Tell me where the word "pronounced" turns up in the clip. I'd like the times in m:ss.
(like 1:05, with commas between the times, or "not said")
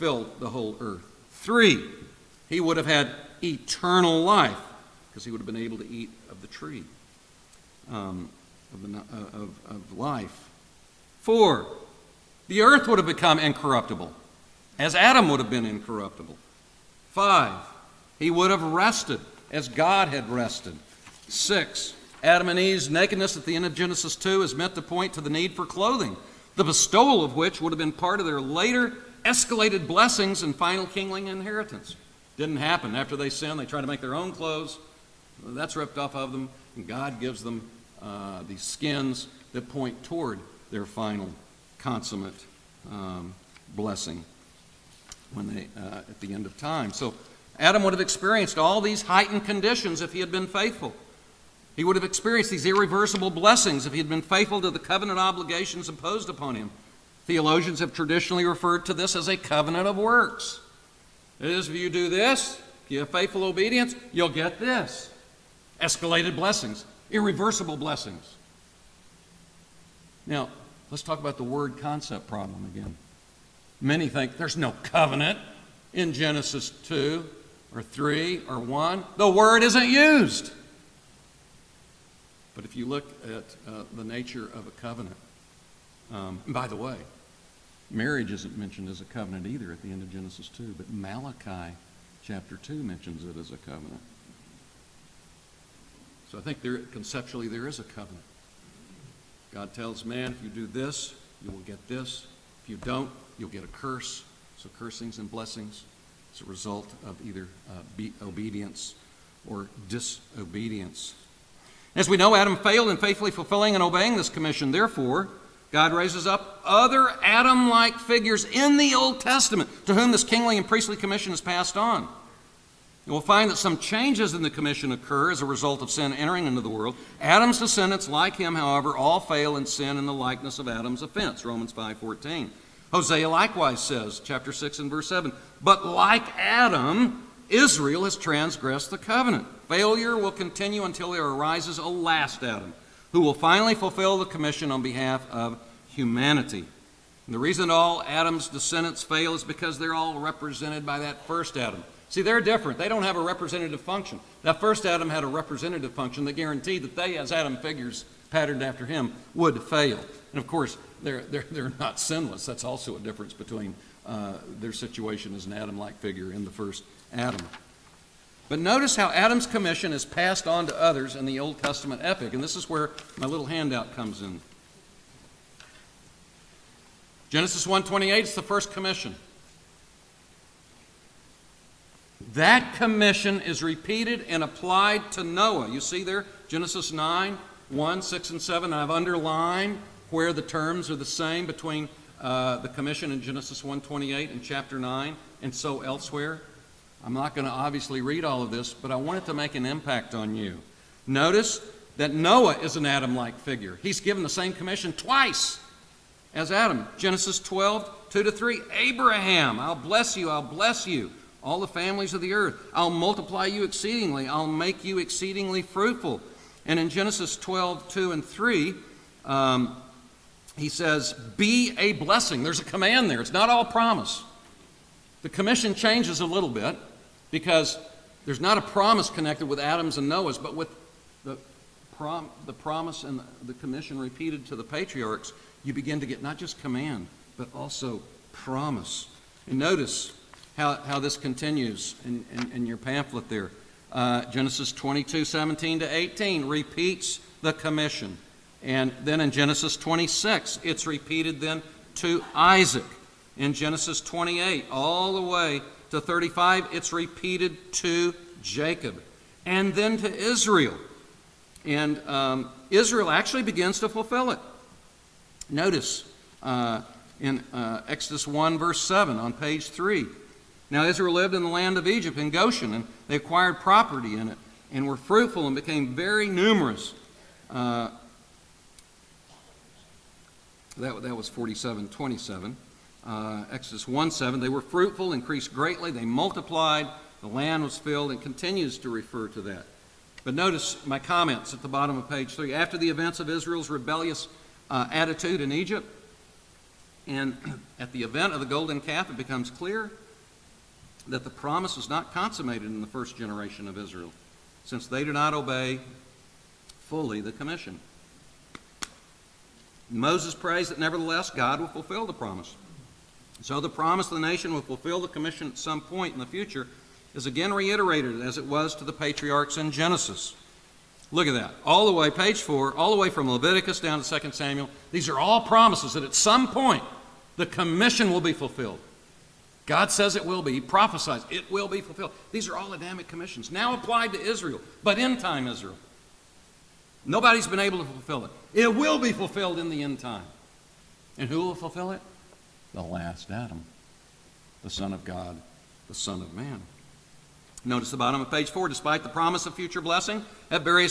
not said.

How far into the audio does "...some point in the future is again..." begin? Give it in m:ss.
5:15.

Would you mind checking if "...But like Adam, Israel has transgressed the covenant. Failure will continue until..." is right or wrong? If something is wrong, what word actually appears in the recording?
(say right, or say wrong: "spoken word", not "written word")
right.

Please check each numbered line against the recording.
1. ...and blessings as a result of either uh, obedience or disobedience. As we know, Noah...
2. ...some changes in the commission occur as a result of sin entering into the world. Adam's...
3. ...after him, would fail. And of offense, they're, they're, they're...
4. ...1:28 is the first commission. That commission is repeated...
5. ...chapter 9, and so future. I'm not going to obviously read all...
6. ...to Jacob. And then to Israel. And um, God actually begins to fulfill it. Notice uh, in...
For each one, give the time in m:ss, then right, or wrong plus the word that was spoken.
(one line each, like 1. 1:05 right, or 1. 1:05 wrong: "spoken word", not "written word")
1. 1:45 wrong: "Adam", not "Noah"
2. 2:03 right
3. 2:38 wrong: "course", not "offense"
4. 2:57 right
5. 3:14 wrong: "elsewhere", not "future"
6. 4:17 wrong: "Israel", not "God".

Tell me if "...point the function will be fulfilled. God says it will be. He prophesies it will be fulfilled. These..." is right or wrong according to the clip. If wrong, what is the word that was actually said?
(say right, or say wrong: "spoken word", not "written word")
wrong: "commission", not "function".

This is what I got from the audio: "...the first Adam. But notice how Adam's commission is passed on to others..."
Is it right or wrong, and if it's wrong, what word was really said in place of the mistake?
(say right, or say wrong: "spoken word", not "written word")
right.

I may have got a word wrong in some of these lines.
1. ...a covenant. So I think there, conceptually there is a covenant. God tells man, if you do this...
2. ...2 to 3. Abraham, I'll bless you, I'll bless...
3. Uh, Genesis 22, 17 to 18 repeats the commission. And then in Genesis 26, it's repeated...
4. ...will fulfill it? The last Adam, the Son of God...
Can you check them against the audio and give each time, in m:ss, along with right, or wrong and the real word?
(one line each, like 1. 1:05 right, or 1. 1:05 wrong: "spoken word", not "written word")
1. 1:33 right
2. 3:28 right
3. 4:03 right
4. 5:41 right.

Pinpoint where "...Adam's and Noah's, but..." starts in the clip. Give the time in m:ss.
3:49.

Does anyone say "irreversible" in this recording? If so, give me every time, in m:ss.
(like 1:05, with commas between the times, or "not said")
0:52, 1:07.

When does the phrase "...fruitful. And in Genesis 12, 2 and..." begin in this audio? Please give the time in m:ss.
3:35.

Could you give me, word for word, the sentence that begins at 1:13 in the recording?
Many think there's no covenant in Genesis 2 or 3 or 1.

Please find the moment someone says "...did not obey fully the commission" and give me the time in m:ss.
5:05.